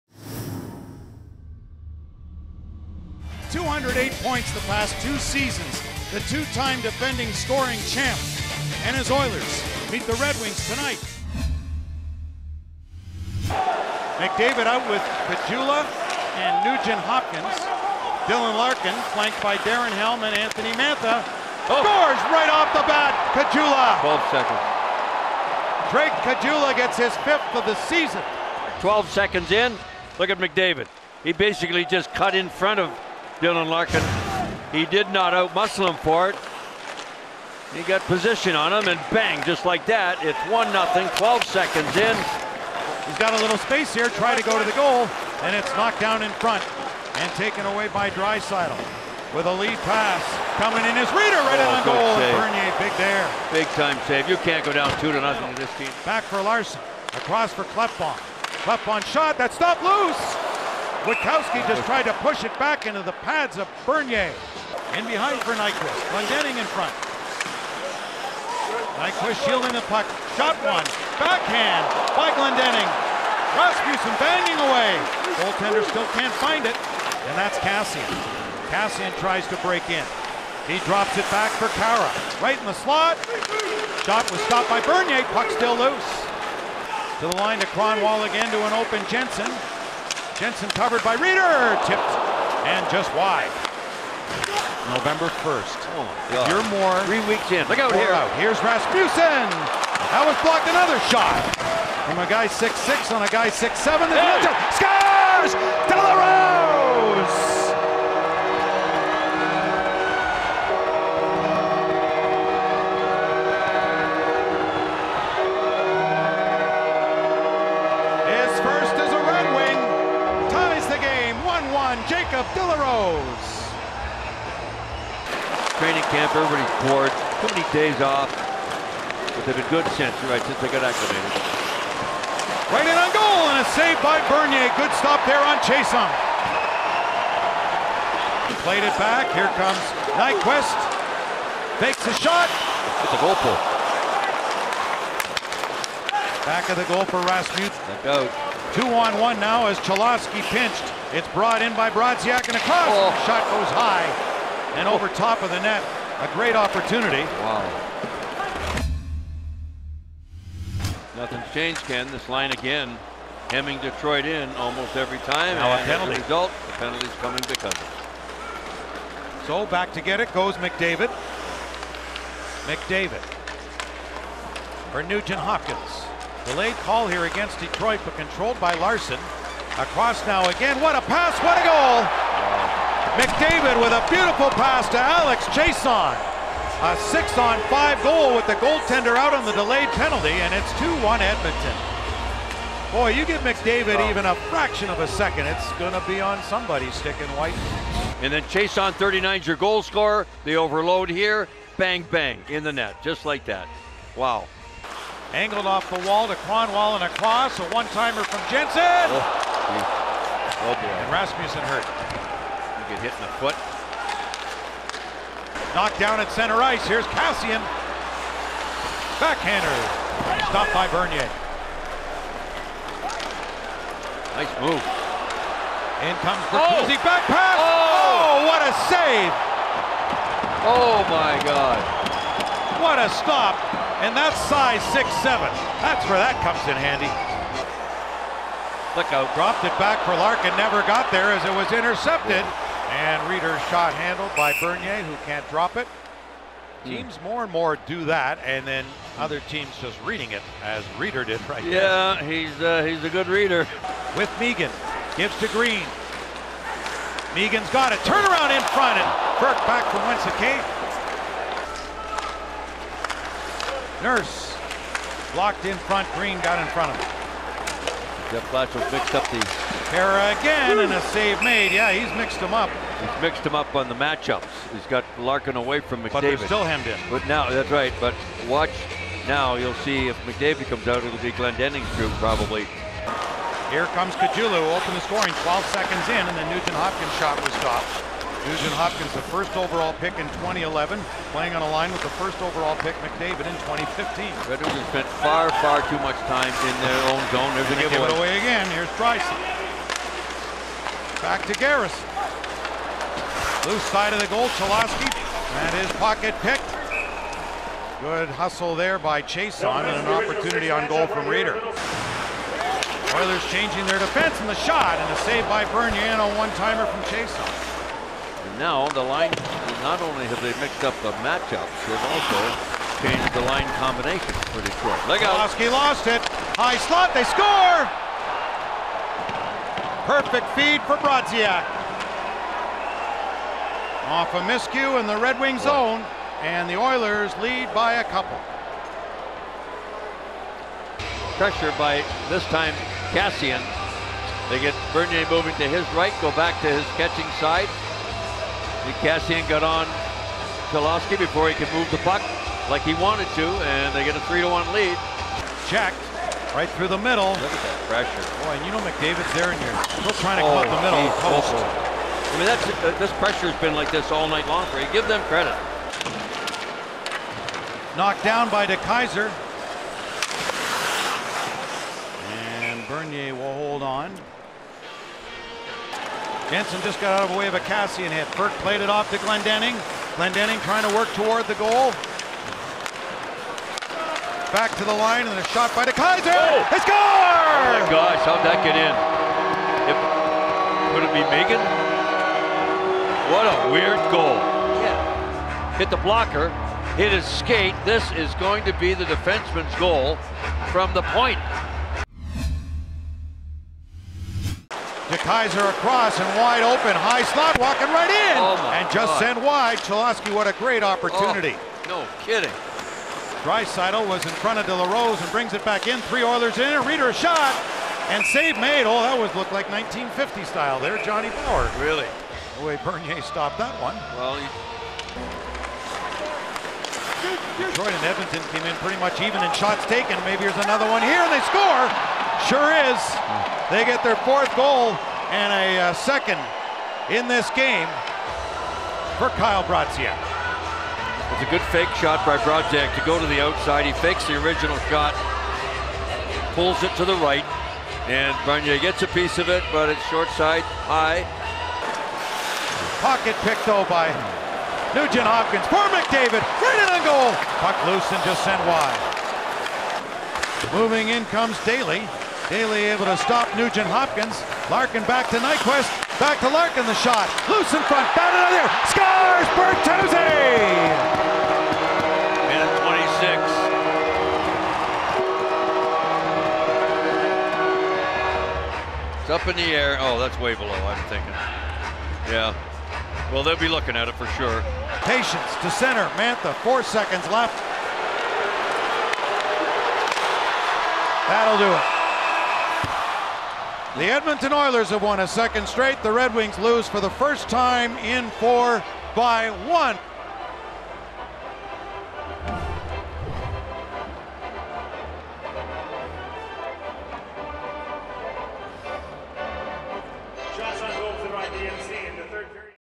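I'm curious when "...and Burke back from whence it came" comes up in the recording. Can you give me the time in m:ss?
4:18.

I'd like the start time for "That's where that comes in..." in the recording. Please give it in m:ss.
3:55.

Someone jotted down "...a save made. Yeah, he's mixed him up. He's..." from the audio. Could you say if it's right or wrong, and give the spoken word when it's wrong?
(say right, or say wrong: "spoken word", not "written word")
right.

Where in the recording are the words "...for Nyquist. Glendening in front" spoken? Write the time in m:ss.
1:05.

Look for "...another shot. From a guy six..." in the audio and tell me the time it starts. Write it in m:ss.
1:40.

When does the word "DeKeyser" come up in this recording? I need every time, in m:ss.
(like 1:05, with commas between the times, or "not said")
6:08, 6:25.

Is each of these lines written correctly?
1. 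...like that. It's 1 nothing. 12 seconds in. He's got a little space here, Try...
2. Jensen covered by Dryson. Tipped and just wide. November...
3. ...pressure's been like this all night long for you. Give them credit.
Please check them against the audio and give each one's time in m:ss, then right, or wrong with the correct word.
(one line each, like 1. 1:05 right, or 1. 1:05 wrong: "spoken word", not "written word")
1. 0:39 right
2. 1:30 wrong: "Rieder", not "Dryson"
3. 6:03 right.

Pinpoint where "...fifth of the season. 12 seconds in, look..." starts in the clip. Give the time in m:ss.
0:27.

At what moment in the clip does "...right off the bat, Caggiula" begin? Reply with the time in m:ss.
0:22.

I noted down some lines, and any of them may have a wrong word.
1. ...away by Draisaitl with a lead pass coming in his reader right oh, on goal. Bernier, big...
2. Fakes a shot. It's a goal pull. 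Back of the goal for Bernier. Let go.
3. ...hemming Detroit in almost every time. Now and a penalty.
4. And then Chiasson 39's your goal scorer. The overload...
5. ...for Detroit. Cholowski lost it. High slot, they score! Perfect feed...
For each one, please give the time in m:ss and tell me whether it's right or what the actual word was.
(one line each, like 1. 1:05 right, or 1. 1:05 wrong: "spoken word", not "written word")
1. 0:47 right
2. 2:21 wrong: "Rasmussen", not "Bernier"
3. 2:43 right
4. 3:18 right
5. 5:24 right.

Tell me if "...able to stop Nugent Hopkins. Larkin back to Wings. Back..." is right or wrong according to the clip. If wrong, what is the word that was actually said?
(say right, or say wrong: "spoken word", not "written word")
wrong: "Nyquist", not "Wings".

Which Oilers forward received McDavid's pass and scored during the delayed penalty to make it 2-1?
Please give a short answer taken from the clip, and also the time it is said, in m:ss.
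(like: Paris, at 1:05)
Alex Chiasson, at 3:04.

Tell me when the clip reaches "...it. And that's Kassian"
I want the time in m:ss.
1:16.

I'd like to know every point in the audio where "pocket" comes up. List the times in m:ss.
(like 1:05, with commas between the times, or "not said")
5:06, 7:33.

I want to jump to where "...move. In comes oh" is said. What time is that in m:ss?
3:44.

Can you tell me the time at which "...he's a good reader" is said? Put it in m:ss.
4:12.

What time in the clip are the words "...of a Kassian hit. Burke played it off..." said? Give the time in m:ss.
6:17.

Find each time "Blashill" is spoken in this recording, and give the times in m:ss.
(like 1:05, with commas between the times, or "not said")
4:28.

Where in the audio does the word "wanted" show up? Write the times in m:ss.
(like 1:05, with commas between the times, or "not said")
5:52.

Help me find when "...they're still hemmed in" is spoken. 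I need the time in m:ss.
4:36.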